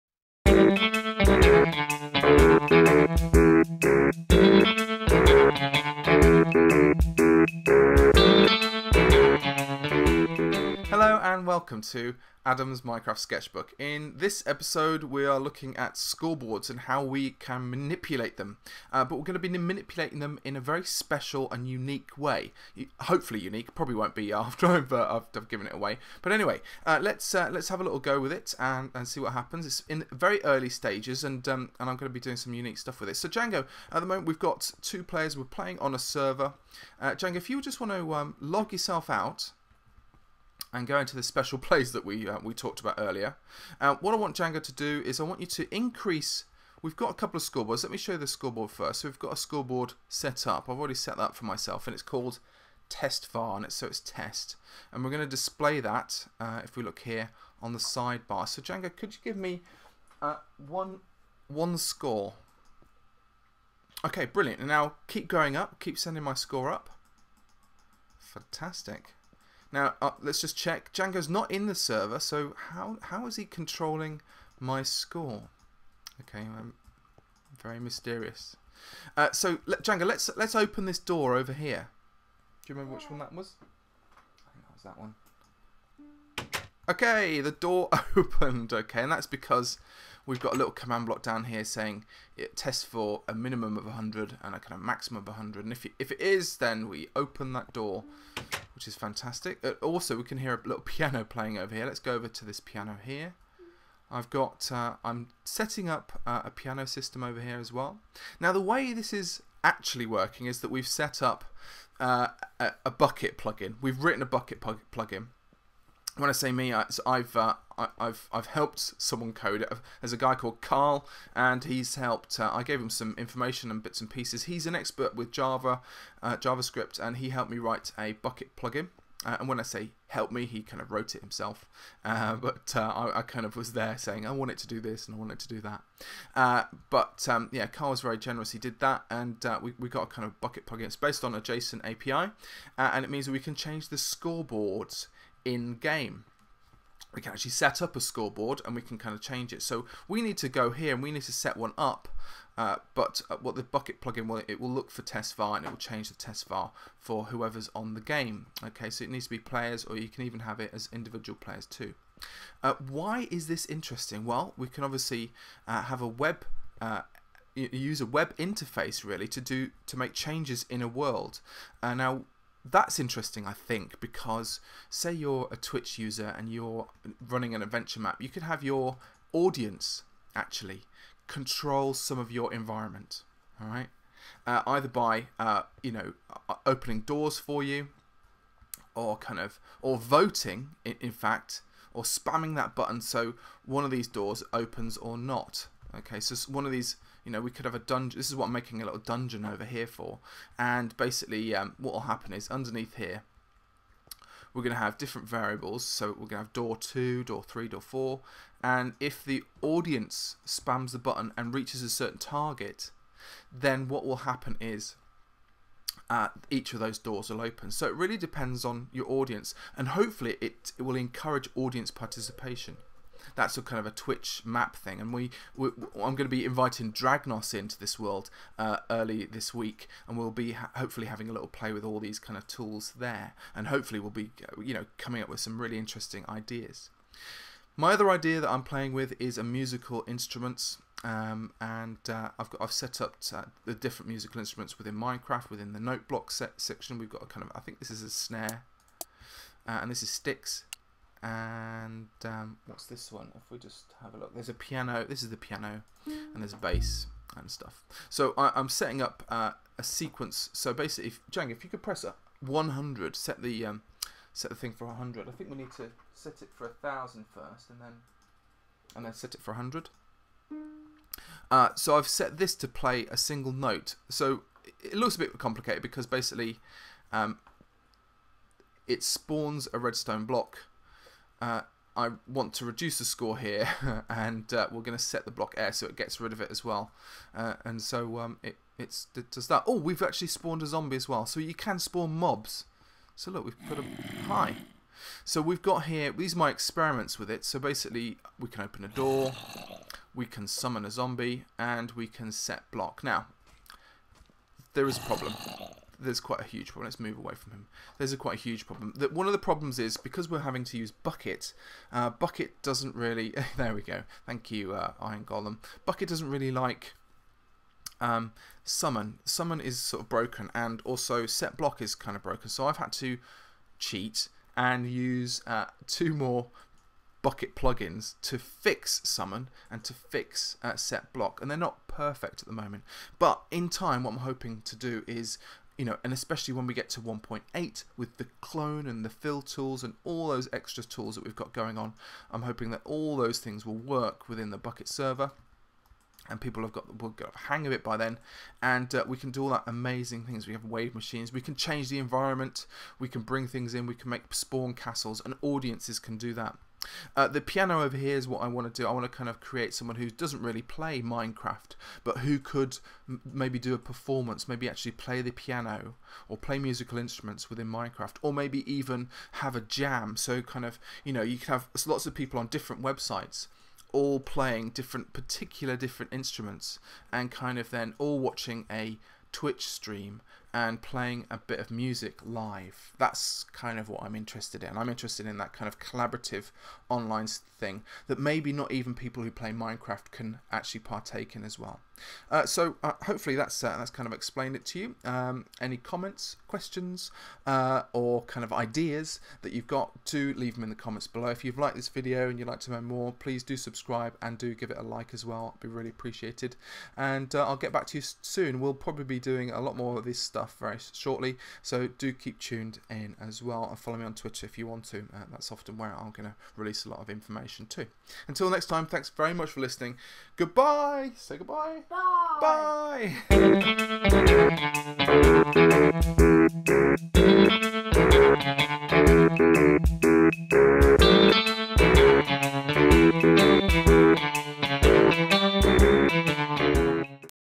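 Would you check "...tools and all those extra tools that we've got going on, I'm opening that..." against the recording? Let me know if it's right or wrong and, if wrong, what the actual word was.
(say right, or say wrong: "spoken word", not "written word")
wrong: "hoping", not "opening".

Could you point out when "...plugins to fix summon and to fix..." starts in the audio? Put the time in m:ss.
5:27.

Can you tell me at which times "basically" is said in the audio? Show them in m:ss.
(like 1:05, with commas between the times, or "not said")
3:20, 4:20, 4:36, 4:57.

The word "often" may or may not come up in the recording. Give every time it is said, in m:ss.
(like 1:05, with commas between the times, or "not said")
6:55.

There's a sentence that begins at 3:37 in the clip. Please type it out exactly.
So it really depends on your audience.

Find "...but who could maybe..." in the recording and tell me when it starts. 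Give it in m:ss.
6:02.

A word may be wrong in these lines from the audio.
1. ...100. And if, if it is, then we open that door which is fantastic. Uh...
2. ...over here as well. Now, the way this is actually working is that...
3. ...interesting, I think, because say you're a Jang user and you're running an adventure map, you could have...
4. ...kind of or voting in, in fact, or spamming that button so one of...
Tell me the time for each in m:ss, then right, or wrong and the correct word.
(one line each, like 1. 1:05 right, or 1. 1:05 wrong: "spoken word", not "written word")
1. 1:35 right
2. 1:47 right
3. 2:52 wrong: "Twitch", not "Jang"
4. 3:09 right.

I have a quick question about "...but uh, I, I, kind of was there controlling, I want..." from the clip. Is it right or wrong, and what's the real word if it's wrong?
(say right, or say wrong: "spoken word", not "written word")
wrong: "saying", not "controlling".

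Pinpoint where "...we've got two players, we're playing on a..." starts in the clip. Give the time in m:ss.
0:34.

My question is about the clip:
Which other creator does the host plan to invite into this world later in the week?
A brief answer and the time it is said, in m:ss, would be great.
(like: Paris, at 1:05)
Dragnos, at 3:46.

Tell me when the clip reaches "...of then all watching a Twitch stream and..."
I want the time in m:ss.
6:17.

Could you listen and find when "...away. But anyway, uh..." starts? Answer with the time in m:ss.
0:25.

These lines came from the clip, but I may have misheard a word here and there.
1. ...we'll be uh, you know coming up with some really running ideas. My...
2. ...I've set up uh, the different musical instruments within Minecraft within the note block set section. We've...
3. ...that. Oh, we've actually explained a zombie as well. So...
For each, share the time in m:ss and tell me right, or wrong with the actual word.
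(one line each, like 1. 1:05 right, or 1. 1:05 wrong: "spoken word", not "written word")
1. 3:53 wrong: "interesting", not "running"
2. 4:02 right
3. 4:49 wrong: "spawned", not "explained".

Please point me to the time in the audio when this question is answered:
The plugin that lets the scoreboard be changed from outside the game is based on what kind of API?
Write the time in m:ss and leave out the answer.
2:21.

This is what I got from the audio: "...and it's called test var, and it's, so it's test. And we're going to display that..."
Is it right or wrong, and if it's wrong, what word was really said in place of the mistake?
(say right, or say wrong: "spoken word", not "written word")
right.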